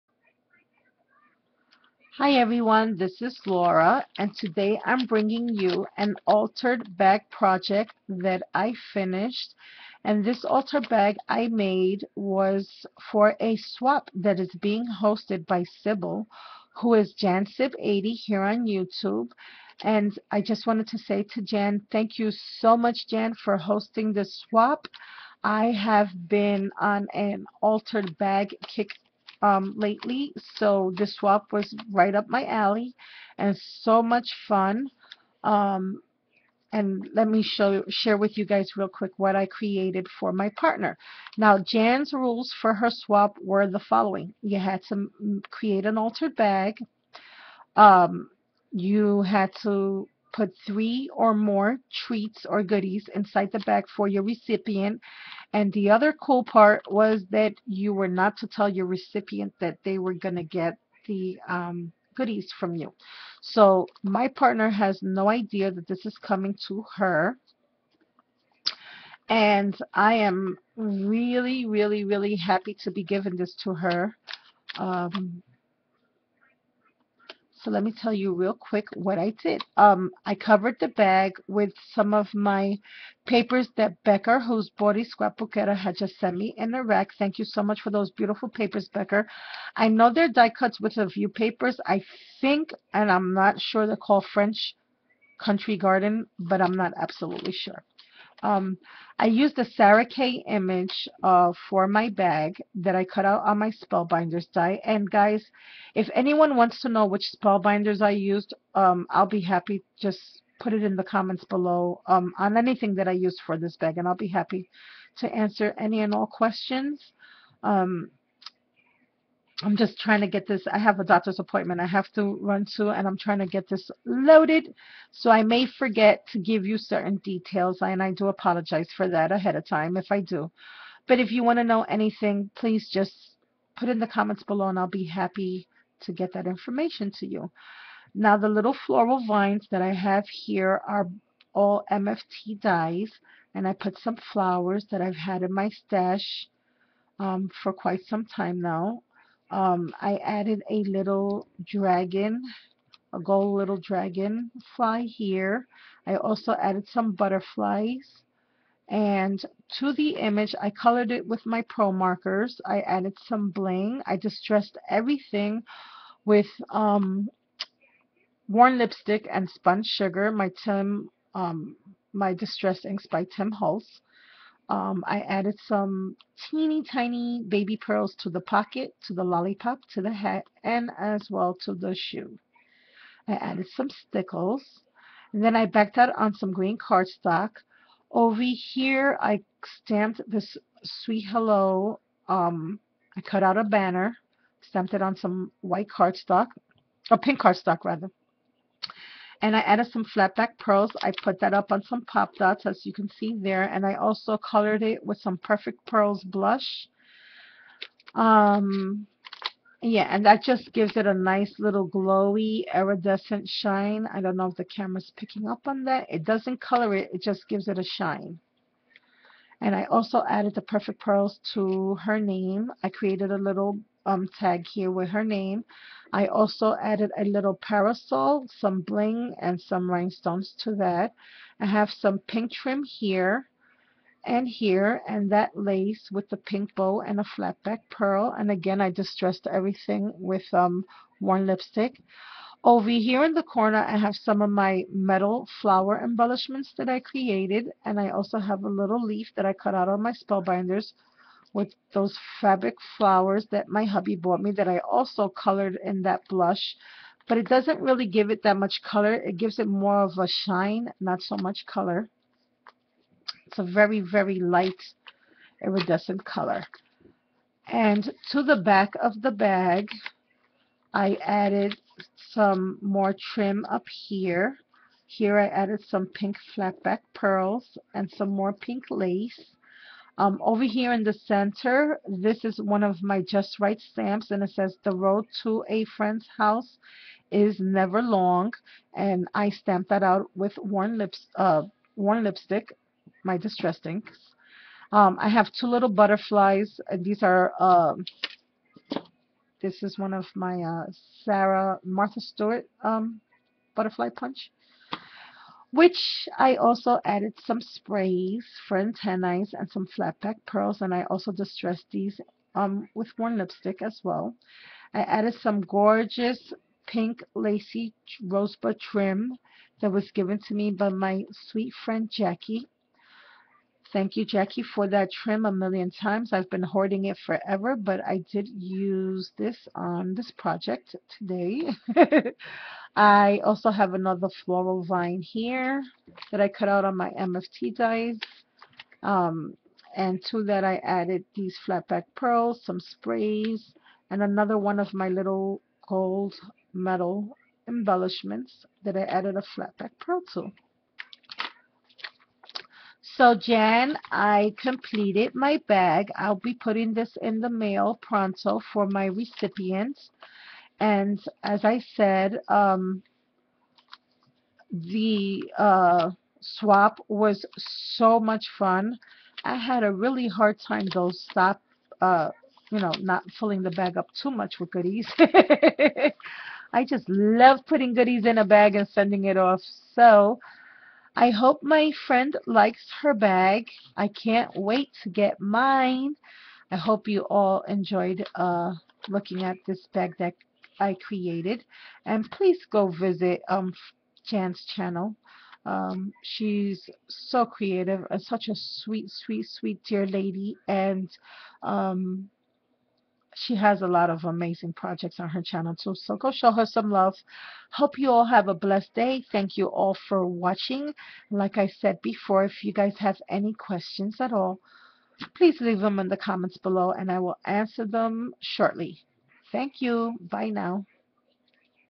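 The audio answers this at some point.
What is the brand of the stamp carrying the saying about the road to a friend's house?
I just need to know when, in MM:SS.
04:43.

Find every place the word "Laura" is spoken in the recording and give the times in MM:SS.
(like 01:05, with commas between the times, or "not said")
00:03.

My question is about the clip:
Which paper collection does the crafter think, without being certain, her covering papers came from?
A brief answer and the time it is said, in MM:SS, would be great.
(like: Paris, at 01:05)
French Country Garden, at 01:34.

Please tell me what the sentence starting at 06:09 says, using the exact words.
I had a really hard time though stop, uh, you know, not filling the bag up too much with goodies.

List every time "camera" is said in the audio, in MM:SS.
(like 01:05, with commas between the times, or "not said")
03:34.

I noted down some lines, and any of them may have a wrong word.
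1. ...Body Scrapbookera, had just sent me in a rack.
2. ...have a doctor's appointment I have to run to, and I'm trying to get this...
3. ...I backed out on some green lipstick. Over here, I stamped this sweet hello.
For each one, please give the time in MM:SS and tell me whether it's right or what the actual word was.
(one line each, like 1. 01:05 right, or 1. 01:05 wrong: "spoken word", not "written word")
1. 01:24 right
2. 02:00 right
3. 03:05 wrong: "cardstock", not "lipstick".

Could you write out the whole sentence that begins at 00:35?
Um, and let me show share with you guys real quick what I created for my partner.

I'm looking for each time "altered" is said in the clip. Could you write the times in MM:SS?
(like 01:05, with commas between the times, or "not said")
00:06, 00:10, 00:27, 00:45.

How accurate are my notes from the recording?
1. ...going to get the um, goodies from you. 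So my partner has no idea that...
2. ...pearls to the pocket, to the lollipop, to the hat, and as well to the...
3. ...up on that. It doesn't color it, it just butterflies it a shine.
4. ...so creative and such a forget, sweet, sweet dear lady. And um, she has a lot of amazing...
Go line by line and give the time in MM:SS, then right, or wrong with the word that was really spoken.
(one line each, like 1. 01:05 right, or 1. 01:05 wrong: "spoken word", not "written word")
1. 01:00 right
2. 02:57 right
3. 03:35 wrong: "gives", not "butterflies"
4. 06:37 wrong: "sweet", not "forget".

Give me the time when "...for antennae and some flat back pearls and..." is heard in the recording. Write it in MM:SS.
05:08.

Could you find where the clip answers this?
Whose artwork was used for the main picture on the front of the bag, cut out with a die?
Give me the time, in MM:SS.
01:39.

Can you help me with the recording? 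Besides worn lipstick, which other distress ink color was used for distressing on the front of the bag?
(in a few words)
Spun sugar.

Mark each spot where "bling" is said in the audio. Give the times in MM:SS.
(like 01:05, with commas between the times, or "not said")
02:43, 03:48.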